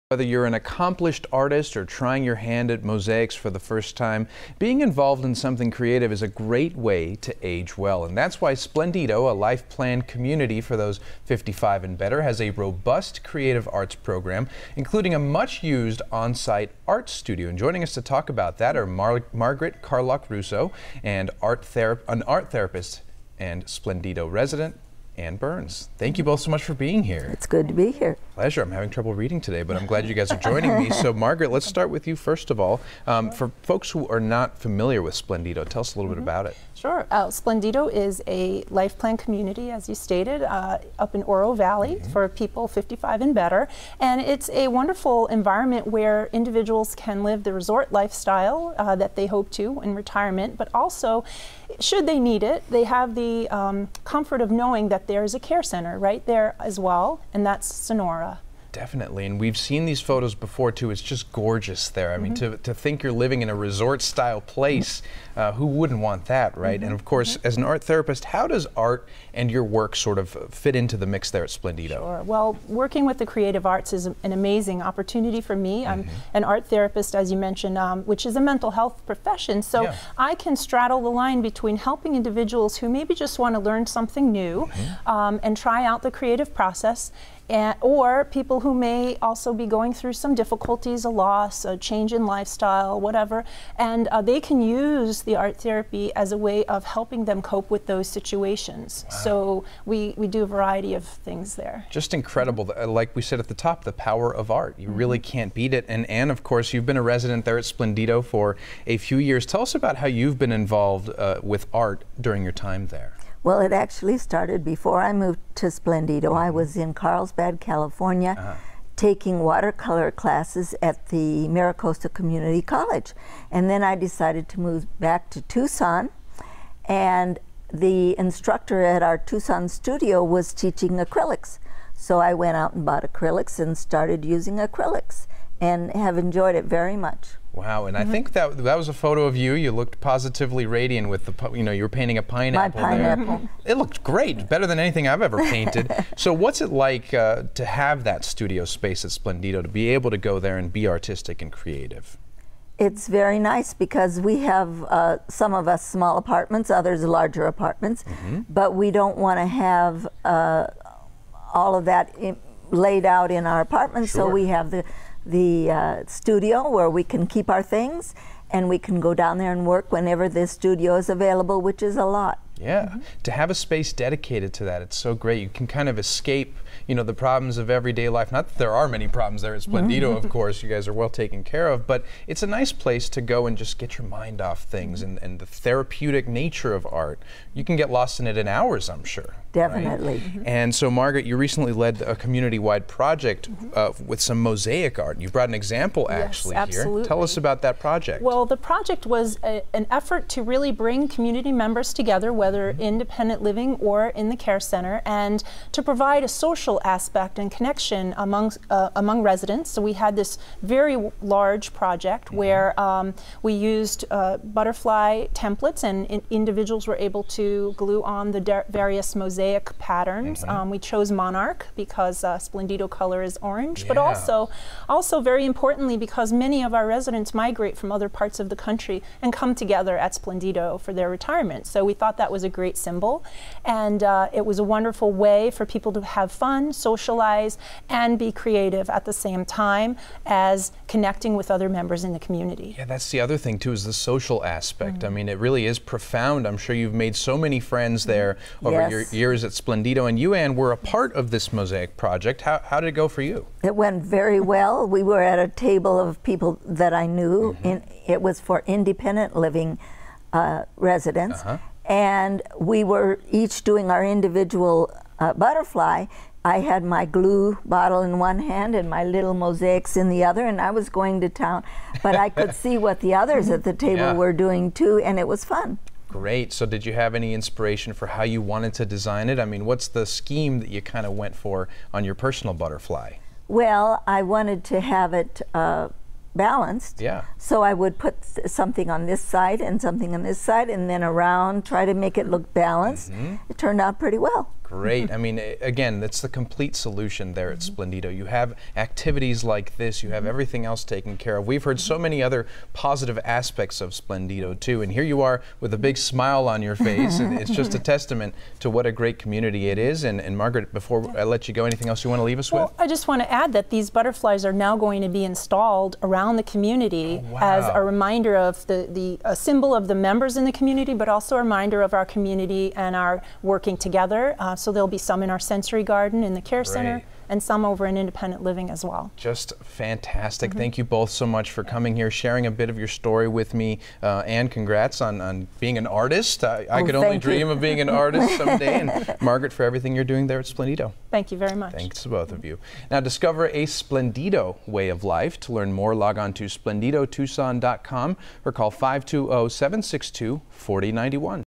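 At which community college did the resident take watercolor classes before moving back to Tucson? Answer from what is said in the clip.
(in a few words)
MiraCosta Community College.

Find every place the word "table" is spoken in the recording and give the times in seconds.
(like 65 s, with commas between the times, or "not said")
255 s, 273 s.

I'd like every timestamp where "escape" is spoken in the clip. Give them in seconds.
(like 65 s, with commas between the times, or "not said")
175 s.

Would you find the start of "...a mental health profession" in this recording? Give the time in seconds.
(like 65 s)
78 s.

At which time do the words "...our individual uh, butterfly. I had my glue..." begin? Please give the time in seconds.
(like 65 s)
263 s.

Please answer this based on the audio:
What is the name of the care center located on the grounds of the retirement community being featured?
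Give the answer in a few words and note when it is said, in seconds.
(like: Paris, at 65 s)
Sonora, at 57 s.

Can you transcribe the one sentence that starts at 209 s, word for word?
So we had this very large project mm -hmm.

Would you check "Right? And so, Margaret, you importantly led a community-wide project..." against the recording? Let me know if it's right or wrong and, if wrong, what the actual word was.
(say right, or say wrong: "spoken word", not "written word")
wrong: "recently", not "importantly".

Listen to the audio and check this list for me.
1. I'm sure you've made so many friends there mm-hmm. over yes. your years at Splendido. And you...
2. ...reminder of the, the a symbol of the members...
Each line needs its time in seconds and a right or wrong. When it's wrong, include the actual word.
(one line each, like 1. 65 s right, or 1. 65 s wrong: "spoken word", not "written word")
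1. 246 s right
2. 317 s right.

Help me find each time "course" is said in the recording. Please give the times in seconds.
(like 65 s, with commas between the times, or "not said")
67 s, 106 s, 180 s.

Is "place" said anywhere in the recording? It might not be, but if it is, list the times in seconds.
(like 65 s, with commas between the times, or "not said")
64 s, 182 s.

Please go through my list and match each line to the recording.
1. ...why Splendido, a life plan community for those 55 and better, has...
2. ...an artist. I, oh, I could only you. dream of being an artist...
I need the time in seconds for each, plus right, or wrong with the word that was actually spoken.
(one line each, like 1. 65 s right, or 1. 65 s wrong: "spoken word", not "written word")
1. 8 s right
2. 335 s right.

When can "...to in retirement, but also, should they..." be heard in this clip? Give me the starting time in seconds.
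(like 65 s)
49 s.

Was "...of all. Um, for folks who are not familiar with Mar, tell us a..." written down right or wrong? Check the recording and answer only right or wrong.
wrong.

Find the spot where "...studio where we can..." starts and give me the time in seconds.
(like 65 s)
166 s.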